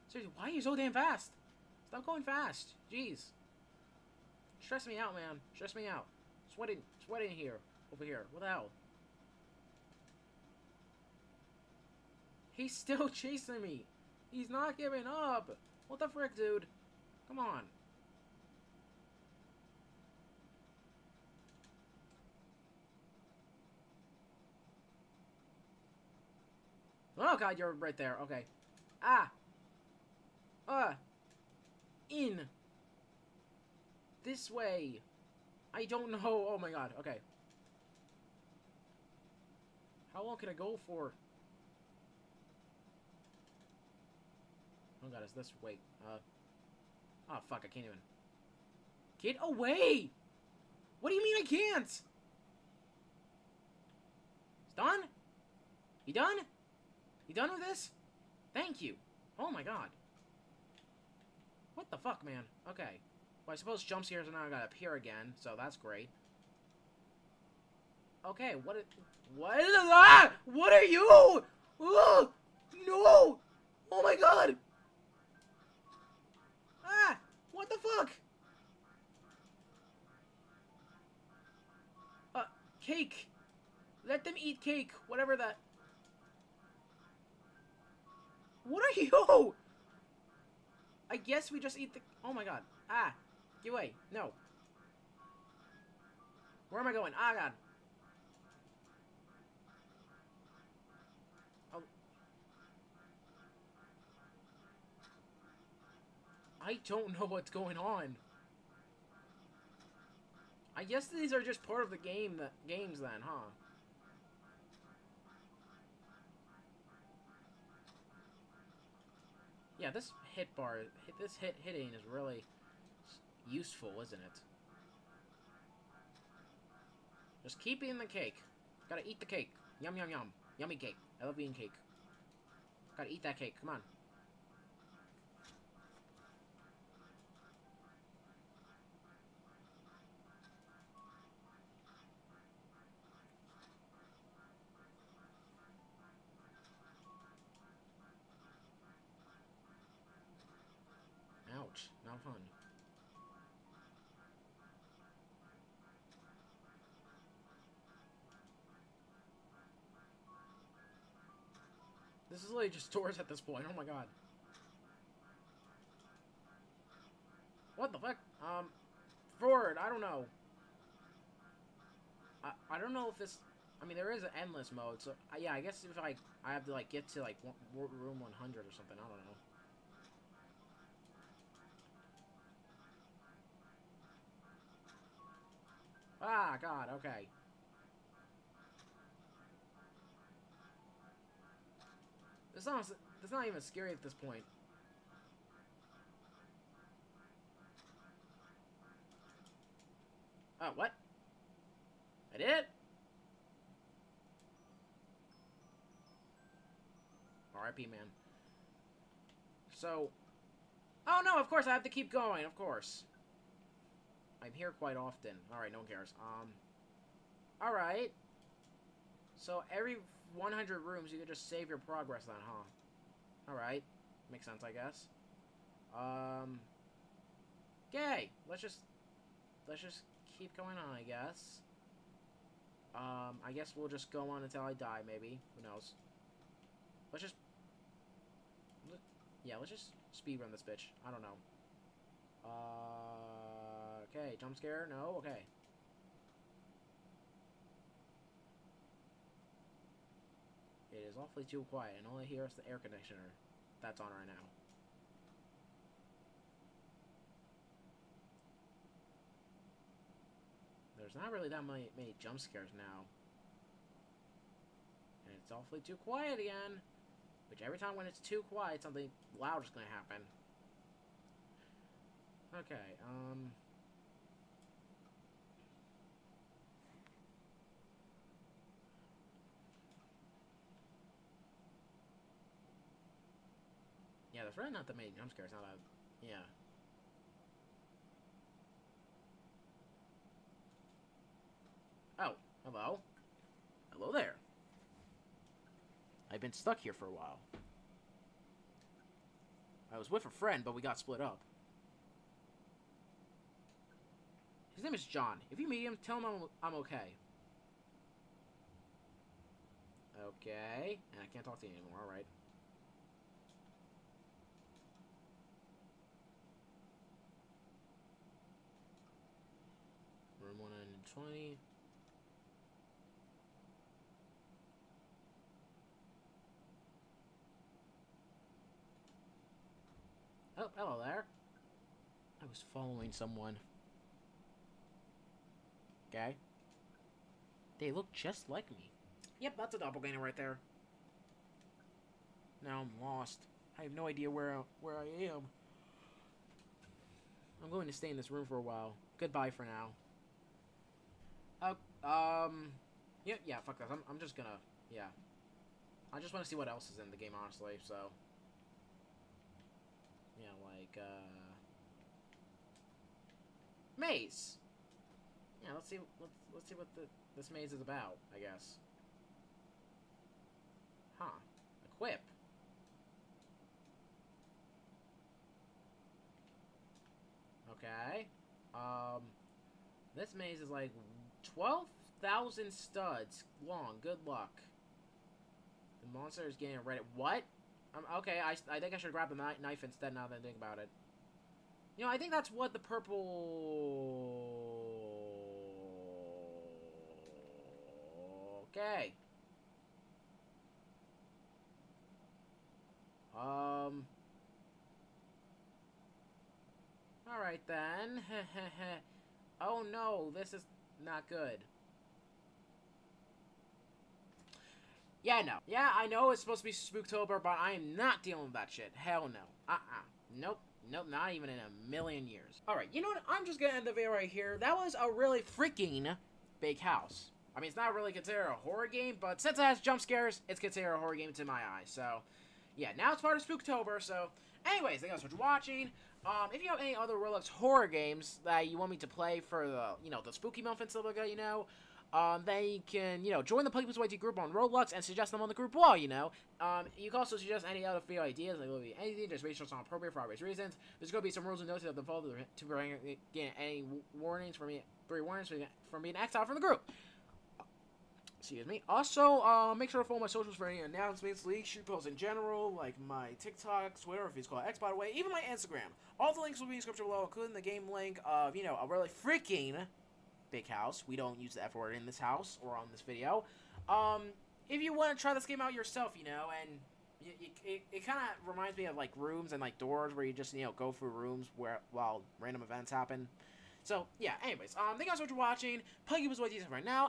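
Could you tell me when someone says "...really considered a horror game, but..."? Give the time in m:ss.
7:07.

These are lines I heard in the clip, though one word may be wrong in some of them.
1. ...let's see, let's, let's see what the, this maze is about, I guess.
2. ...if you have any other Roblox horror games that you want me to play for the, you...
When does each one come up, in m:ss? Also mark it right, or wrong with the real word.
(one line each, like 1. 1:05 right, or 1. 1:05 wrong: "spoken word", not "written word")
1. 6:05 right
2. 7:16 right.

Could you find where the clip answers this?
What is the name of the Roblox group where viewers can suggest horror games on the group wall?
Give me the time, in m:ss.
7:23.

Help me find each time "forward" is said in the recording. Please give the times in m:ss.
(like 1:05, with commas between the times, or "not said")
2:49.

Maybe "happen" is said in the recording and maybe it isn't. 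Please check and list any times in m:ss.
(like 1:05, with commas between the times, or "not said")
4:29, 8:02.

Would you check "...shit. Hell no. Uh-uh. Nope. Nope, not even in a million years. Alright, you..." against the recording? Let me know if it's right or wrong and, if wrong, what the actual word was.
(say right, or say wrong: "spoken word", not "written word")
right.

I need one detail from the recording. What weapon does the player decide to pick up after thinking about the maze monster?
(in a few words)
knife.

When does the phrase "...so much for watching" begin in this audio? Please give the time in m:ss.
8:05.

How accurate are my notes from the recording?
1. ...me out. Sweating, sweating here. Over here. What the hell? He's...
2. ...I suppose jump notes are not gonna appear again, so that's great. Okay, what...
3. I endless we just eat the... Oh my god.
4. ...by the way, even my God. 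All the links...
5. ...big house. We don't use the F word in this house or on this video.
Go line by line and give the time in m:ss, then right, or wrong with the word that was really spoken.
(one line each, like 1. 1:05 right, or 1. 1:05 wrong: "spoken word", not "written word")
1. 0:05 right
2. 1:03 wrong: "scares", not "notes"
3. 1:31 wrong: "guess", not "endless"
4. 7:44 wrong: "Instagram", not "God"
5. 7:50 right.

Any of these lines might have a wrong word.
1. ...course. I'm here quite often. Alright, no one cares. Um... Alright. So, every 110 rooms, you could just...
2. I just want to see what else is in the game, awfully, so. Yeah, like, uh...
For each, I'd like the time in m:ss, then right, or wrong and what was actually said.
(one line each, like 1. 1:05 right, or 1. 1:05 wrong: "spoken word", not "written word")
1. 3:32 wrong: "100", not "110"
2. 5:56 wrong: "honestly", not "awfully".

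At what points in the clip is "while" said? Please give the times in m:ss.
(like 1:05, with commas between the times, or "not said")
4:57, 5:48, 8:01.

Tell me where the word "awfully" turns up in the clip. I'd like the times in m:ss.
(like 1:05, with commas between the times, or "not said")
4:11, 4:25.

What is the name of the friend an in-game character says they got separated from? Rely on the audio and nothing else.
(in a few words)
John.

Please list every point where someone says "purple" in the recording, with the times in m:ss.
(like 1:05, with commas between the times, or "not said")
6:32.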